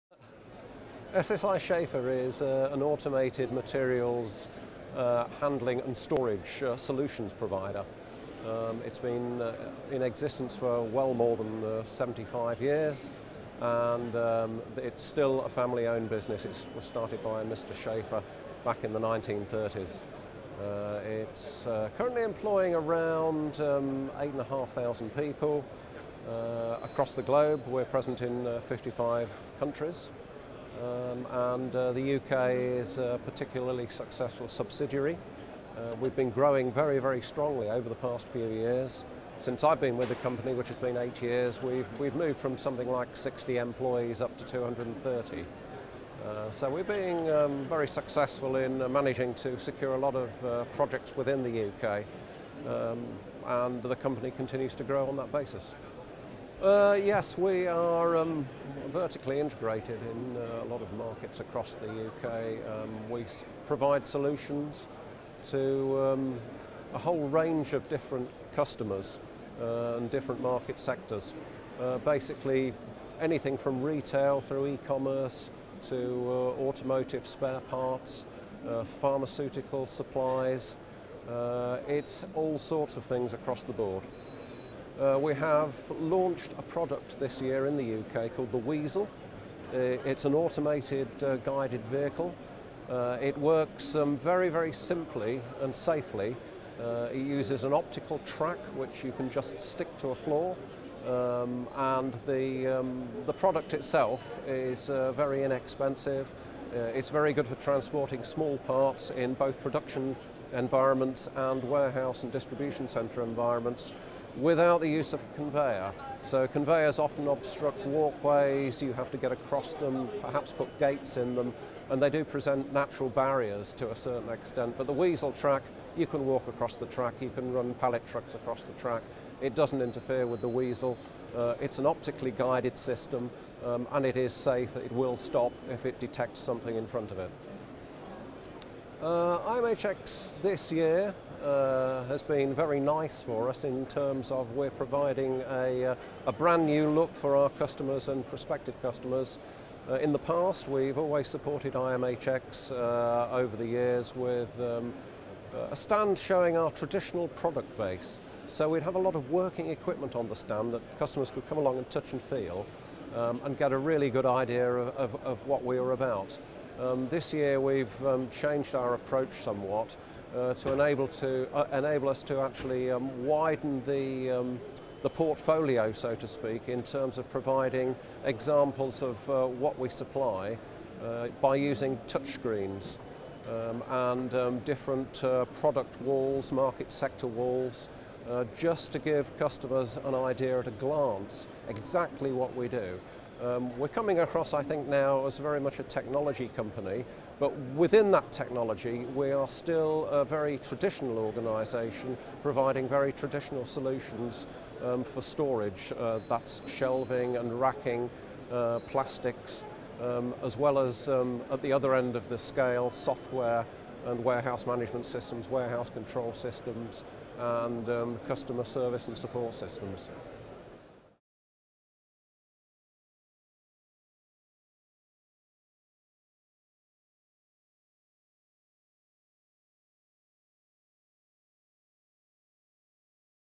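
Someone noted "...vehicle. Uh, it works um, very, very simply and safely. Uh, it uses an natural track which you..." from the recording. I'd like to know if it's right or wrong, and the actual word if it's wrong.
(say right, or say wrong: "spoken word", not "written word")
wrong: "optical", not "natural".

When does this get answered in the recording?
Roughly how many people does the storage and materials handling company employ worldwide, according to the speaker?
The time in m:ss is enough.
0:24.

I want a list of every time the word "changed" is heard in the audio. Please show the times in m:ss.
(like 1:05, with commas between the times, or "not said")
2:48.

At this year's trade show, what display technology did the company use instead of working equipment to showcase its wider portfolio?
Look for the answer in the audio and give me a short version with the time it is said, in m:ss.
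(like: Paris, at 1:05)
touchscreens, at 3:02.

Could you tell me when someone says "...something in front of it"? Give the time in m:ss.
2:16.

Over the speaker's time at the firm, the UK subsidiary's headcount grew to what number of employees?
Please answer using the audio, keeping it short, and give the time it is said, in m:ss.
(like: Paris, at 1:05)
230, at 0:44.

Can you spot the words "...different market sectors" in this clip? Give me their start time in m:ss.
1:10.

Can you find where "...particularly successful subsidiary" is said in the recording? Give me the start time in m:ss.
0:33.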